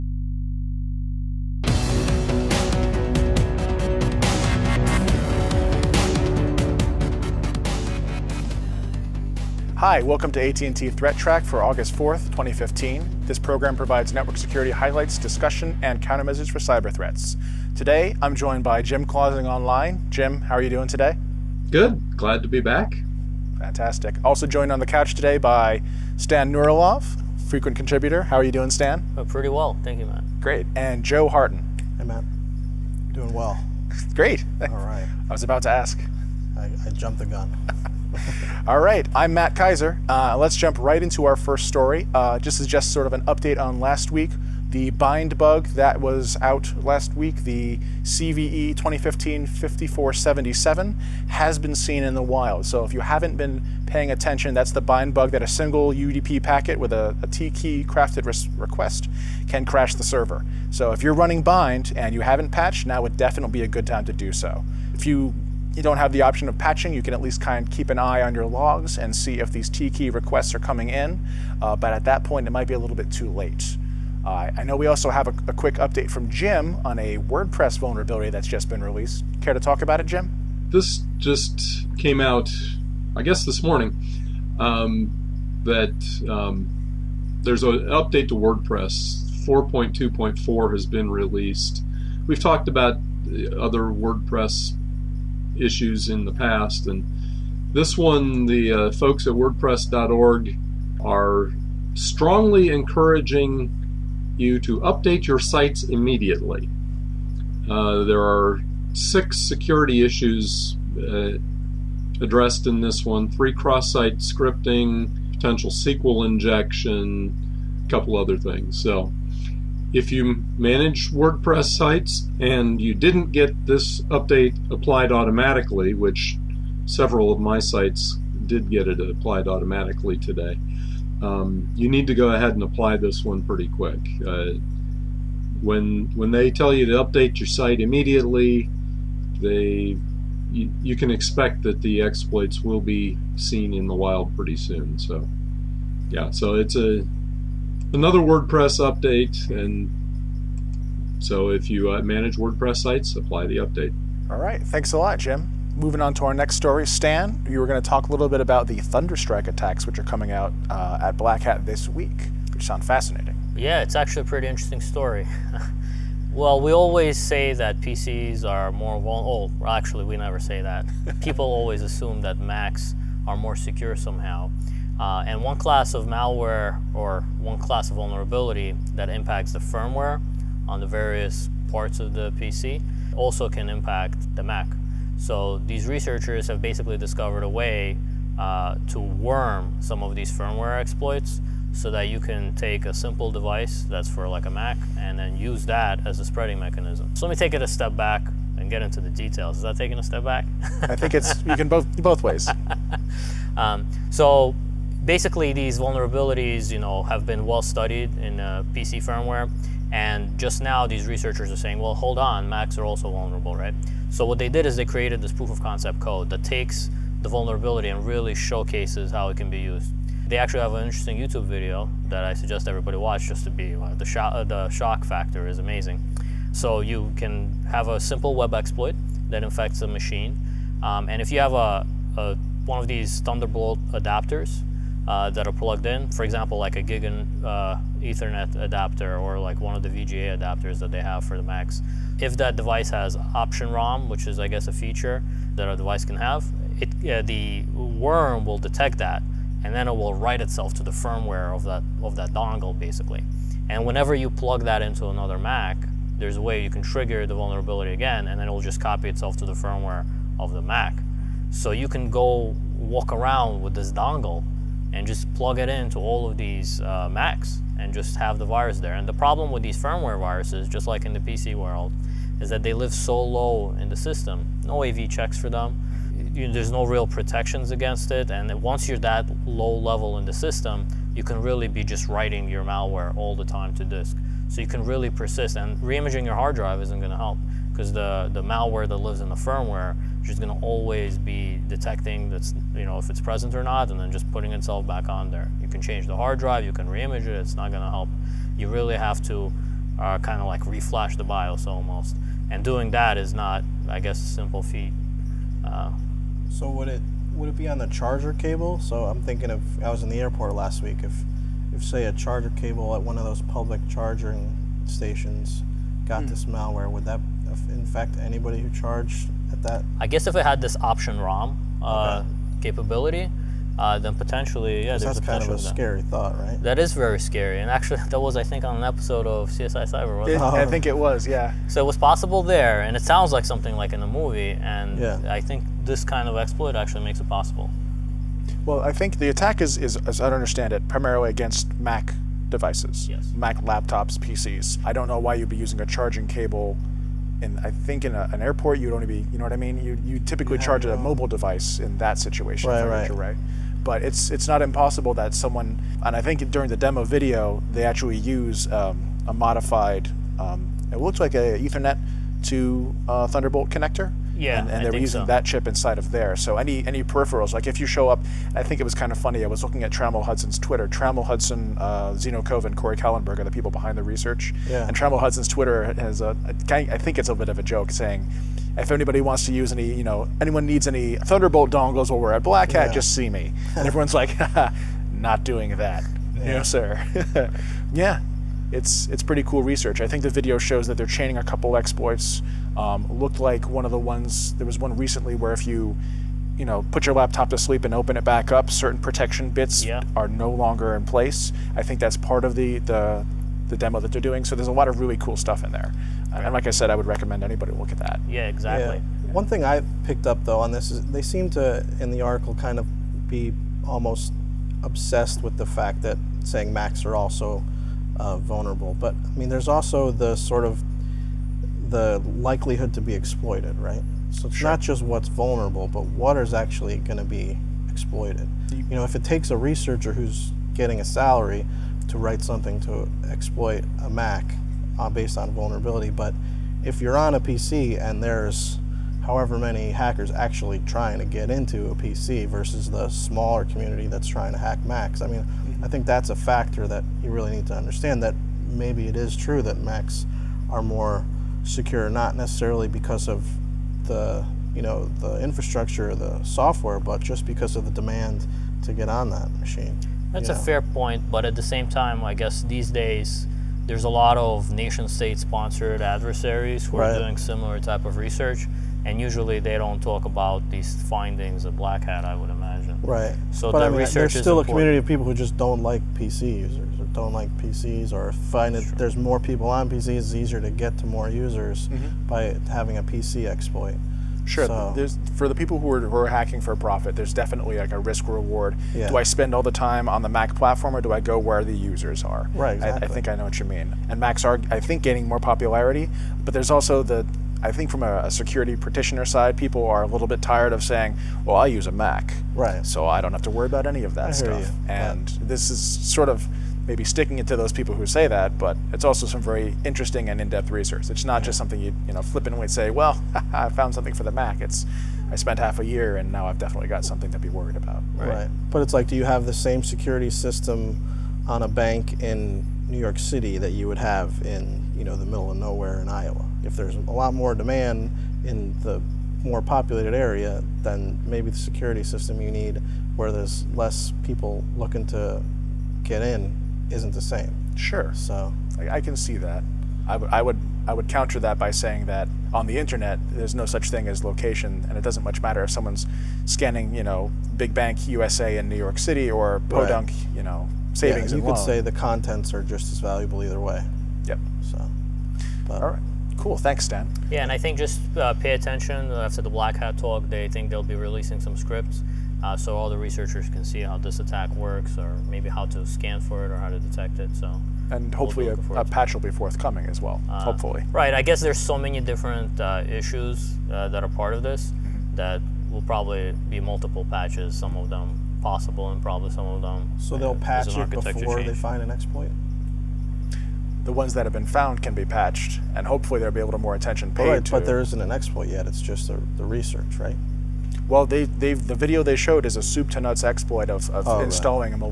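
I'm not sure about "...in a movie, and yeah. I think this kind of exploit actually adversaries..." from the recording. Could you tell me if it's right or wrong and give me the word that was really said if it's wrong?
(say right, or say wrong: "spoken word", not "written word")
wrong: "makes", not "adversaries".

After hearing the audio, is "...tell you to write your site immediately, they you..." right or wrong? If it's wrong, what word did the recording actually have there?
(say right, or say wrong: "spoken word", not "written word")
wrong: "update", not "write".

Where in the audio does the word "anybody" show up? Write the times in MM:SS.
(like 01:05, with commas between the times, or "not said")
05:18, 06:18, 06:47.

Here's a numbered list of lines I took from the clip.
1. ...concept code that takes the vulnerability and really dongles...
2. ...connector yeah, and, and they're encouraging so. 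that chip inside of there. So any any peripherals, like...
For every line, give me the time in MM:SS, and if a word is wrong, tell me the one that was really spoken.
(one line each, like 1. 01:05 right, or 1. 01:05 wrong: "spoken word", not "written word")
1. 03:35 wrong: "showcases", not "dongles"
2. 06:03 wrong: "using", not "encouraging".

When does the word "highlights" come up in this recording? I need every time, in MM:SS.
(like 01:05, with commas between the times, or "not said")
00:14.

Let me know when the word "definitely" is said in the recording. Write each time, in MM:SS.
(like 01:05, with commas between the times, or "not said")
01:03, 08:07, 08:36.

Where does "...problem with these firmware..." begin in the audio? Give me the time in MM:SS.
04:29.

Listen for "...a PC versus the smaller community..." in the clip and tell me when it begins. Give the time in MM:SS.
07:21.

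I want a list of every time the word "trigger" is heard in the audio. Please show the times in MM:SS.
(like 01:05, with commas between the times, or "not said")
04:16.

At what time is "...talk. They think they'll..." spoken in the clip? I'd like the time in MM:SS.
09:19.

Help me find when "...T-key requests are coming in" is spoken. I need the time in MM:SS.
01:09.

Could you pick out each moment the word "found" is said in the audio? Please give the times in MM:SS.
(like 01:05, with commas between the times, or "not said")
08:33, 09:44.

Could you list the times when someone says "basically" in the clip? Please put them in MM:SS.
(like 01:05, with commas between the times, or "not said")
03:06, 03:25, 04:12.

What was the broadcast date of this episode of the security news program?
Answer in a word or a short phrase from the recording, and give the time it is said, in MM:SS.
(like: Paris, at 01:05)
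August 4th, 2015, at 00:11.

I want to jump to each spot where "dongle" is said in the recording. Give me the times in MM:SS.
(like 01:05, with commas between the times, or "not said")
04:12, 04:23, 06:21.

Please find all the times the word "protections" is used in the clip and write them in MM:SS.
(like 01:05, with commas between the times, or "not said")
04:37, 06:38.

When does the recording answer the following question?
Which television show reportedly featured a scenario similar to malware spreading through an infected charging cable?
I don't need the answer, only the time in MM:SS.
05:29.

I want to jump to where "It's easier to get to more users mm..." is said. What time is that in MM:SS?
08:00.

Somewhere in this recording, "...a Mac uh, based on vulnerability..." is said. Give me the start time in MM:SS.
07:14.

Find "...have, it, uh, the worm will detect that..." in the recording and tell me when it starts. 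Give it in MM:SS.
04:06.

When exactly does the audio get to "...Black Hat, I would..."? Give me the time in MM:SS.
07:51.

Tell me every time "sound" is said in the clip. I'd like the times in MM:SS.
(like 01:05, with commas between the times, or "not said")
02:42, 05:33.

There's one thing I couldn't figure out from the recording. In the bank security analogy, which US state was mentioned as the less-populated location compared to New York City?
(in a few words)
Iowa.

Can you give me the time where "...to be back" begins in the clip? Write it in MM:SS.
00:22.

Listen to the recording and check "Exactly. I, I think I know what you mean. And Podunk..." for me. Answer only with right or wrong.
wrong.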